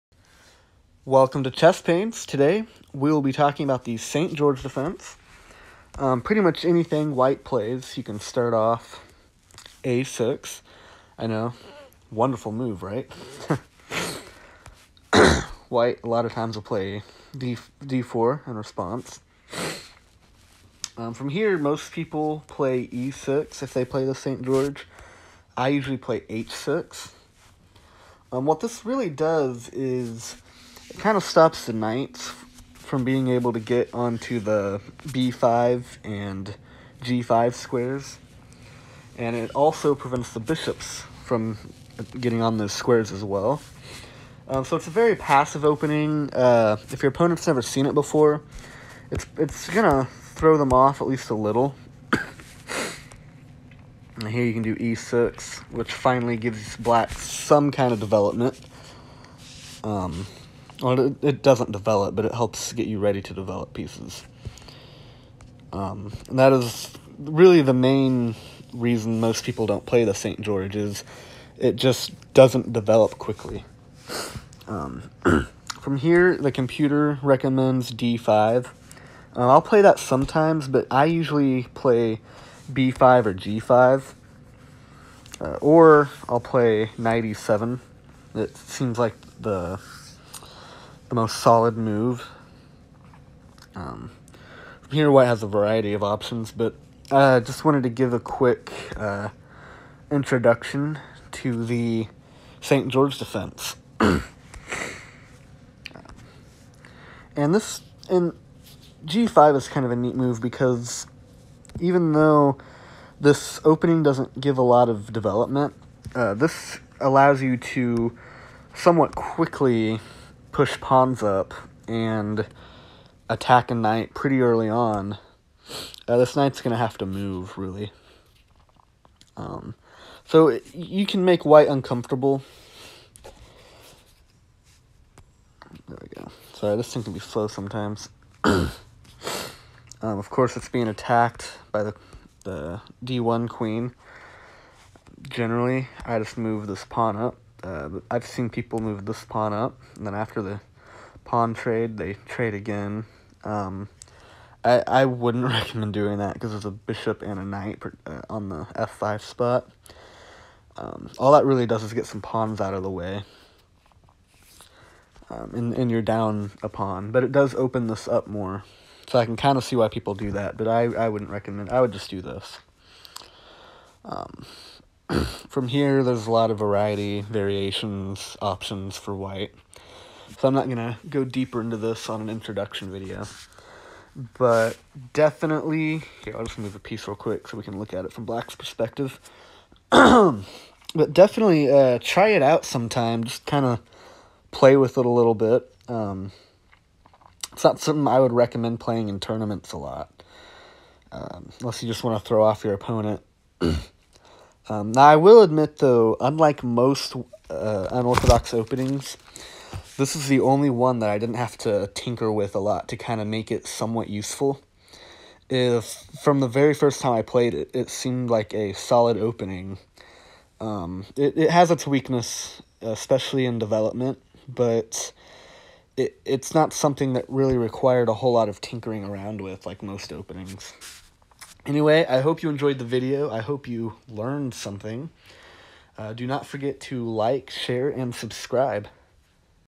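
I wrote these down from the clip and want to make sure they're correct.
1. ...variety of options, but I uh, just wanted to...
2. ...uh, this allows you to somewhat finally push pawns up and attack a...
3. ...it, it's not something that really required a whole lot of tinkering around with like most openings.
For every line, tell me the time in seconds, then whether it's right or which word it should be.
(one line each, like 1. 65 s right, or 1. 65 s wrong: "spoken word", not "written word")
1. 95 s right
2. 116 s wrong: "quickly", not "finally"
3. 225 s right.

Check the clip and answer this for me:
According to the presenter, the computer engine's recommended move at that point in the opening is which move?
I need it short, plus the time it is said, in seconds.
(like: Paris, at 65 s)
d5, at 77 s.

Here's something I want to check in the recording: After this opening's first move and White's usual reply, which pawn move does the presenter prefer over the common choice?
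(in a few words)
h6.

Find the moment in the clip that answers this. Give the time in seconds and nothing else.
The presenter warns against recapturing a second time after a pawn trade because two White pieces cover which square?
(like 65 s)
158 s.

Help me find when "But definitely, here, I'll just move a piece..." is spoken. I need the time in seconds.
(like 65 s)
184 s.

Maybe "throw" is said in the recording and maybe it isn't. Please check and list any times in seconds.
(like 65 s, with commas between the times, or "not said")
50 s, 202 s.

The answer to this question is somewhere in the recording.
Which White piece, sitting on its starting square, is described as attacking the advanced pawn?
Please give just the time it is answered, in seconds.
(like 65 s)
143 s.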